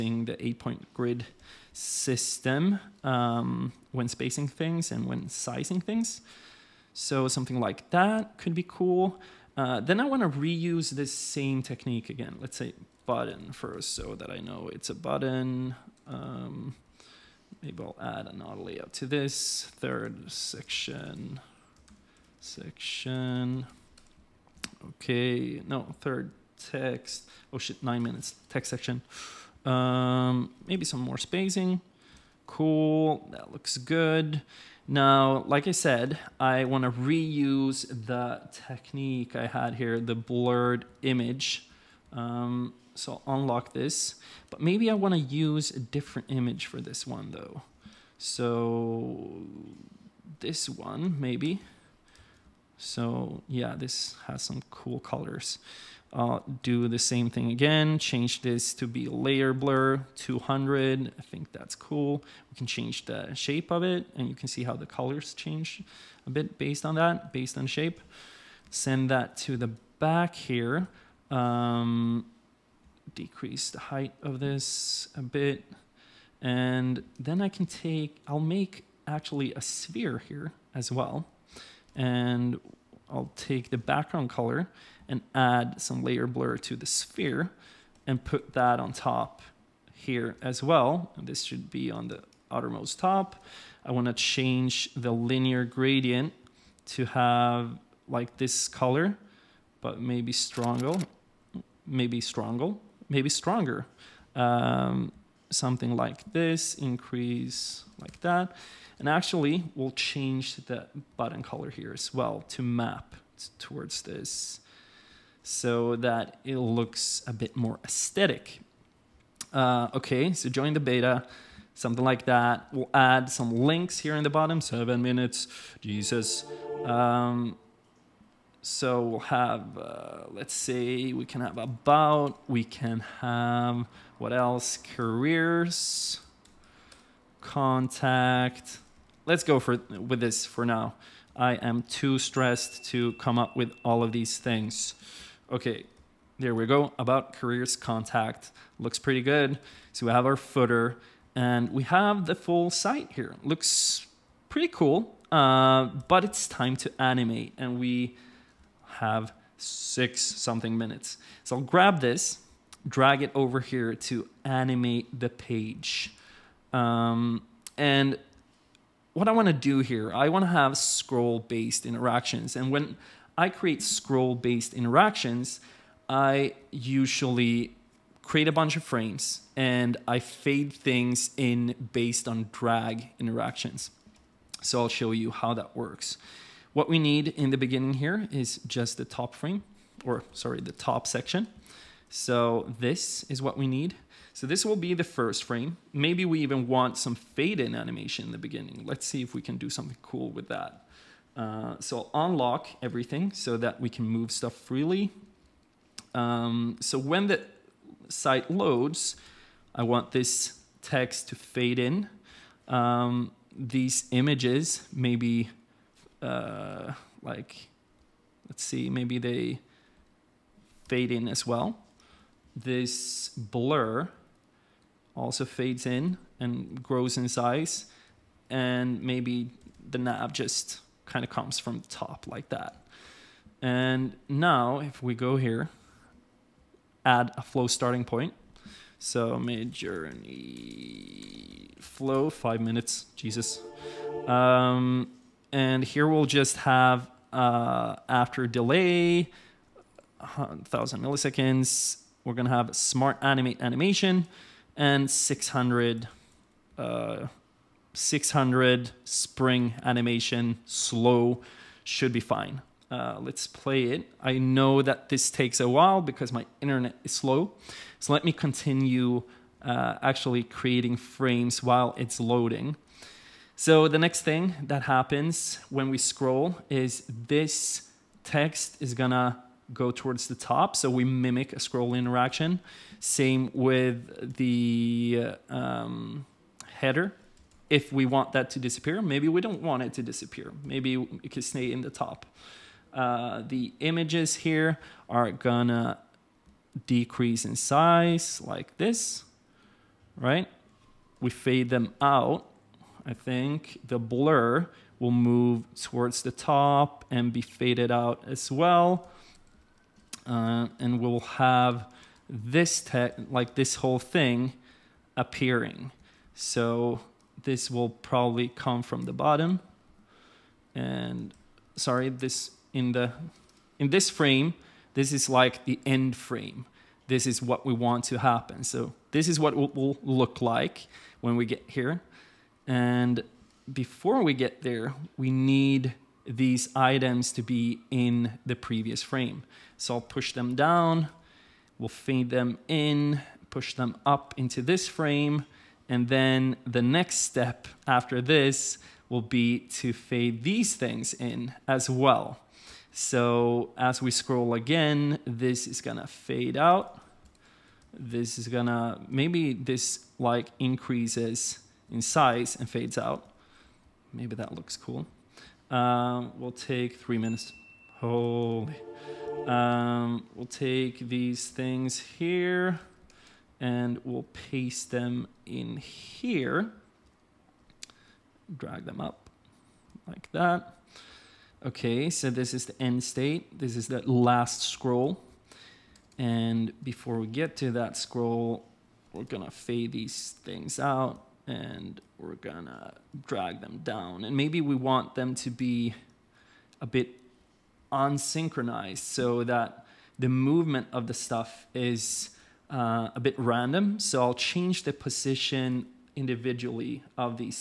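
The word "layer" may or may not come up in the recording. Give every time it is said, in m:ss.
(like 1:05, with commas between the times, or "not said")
0:59, 1:26.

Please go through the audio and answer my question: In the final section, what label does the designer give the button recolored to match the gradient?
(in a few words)
Join the beta.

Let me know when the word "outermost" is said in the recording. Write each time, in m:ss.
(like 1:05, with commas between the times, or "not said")
1:32.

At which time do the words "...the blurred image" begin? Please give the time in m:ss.
0:40.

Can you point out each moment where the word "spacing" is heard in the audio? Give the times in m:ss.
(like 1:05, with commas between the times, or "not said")
0:04, 0:31.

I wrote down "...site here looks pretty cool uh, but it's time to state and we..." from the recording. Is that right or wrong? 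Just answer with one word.
wrong.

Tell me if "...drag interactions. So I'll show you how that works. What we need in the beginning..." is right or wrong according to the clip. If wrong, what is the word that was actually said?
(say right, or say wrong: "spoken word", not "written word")
right.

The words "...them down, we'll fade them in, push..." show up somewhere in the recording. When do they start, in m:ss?
5:40.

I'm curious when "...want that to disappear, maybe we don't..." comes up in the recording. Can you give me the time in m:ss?
4:48.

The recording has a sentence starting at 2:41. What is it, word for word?
So I'll grab this, drag it over here to animate the page.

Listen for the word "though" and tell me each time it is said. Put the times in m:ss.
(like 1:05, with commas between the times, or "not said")
0:47.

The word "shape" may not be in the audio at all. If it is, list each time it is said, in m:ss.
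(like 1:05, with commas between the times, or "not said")
1:03, 1:07.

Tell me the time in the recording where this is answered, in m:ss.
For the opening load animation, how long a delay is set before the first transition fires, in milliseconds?
4:10.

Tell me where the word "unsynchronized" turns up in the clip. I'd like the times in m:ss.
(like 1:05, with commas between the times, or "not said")
6:37.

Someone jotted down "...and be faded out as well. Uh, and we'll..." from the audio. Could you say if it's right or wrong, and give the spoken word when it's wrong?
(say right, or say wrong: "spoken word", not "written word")
right.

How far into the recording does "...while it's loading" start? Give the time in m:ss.
4:31.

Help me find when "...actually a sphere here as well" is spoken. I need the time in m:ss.
1:19.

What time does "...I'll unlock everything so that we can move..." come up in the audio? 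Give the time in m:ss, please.
3:22.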